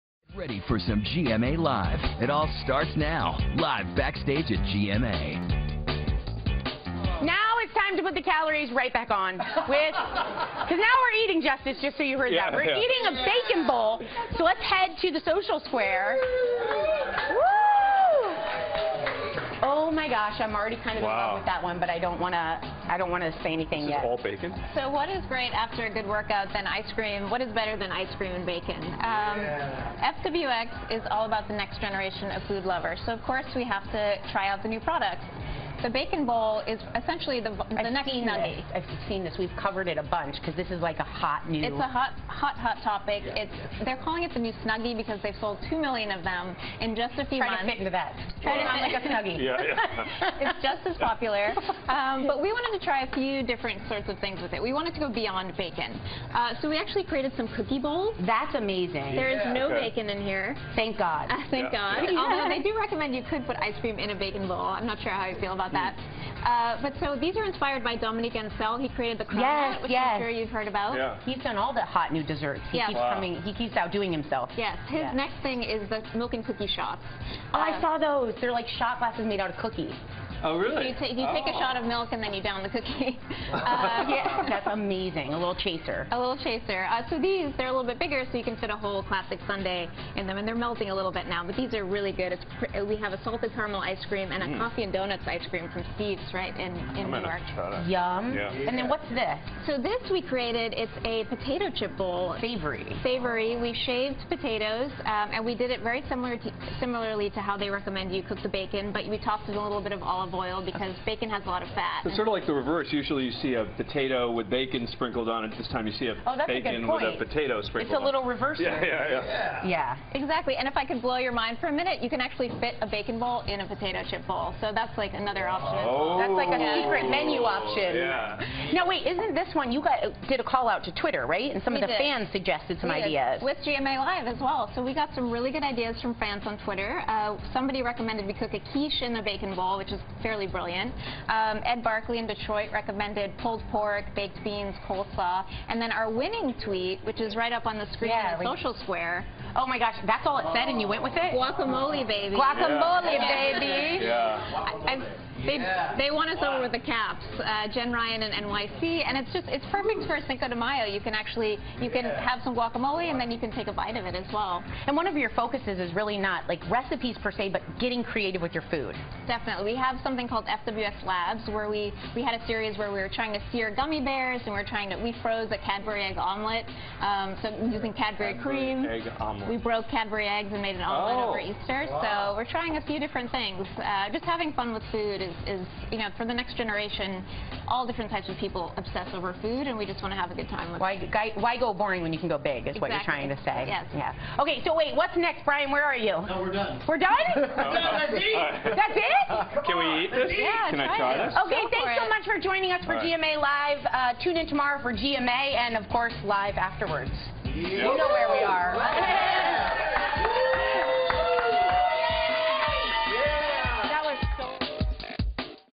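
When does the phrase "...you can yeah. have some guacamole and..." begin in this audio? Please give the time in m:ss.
2:41.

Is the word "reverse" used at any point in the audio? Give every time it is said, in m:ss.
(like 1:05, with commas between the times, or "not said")
1:52, 1:58.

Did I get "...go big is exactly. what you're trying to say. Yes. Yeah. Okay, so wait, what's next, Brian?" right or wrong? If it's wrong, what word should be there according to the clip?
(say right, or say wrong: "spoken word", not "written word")
right.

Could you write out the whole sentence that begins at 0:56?
Uh, so we actually created some cookie bowls.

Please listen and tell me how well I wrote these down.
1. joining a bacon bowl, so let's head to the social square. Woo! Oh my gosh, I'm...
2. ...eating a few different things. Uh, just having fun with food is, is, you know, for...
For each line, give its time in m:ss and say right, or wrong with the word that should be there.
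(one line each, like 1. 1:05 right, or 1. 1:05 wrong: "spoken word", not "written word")
1. 0:12 wrong: "eating", not "joining"
2. 3:02 wrong: "trying", not "eating".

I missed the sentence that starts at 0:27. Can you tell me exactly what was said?
What is better than ice cream and bacon?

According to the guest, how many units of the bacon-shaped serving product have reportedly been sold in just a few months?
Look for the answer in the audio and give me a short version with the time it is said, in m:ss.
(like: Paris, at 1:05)
2 million, at 0:45.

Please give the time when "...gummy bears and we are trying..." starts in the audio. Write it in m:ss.
2:53.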